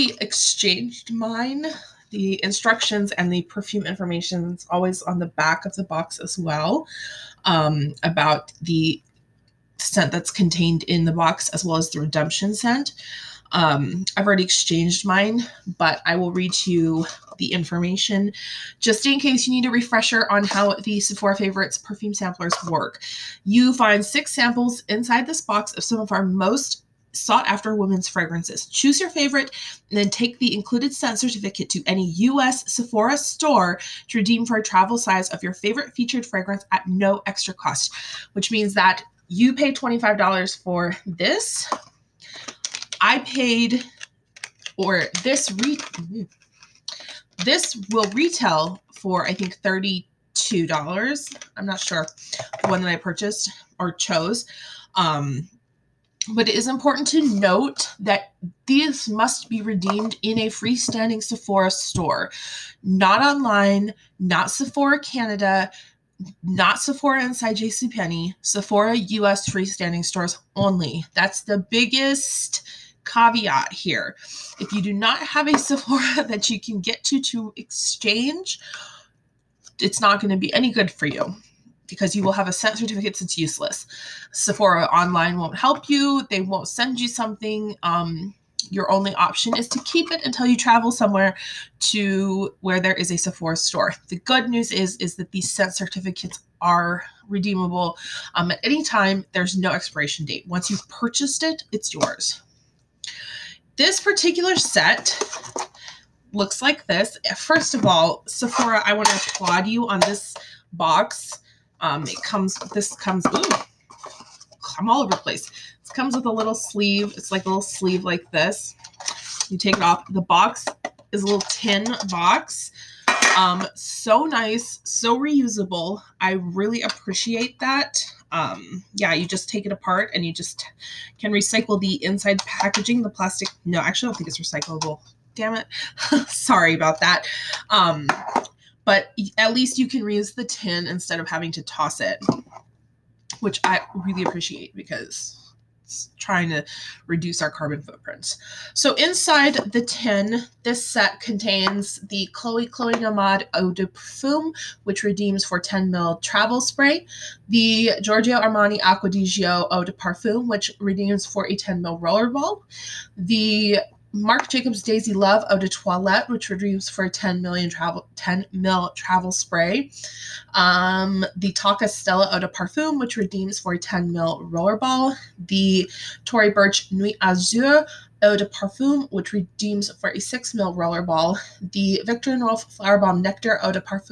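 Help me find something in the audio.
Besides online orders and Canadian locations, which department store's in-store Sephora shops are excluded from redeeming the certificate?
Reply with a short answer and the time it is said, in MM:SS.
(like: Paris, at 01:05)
JCPenney, at 01:07.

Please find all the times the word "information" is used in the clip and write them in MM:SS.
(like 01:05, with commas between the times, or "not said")
00:03, 00:17.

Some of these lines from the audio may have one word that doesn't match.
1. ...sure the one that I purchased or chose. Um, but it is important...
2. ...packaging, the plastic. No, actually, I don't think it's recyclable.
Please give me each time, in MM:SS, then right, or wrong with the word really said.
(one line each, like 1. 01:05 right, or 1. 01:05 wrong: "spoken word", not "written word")
1. 00:51 right
2. 02:12 right.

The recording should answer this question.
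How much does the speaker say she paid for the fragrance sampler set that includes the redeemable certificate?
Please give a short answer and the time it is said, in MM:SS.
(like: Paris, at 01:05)
$25, at 00:39.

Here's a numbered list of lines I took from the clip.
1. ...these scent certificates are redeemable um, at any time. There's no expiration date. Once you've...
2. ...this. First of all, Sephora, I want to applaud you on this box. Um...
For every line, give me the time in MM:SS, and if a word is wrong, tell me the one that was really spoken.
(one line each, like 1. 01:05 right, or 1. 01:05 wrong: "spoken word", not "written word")
1. 01:35 right
2. 01:46 right.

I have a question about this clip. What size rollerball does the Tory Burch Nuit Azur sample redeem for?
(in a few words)
6 ml.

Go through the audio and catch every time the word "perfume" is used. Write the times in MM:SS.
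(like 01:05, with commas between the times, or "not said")
00:03, 00:21.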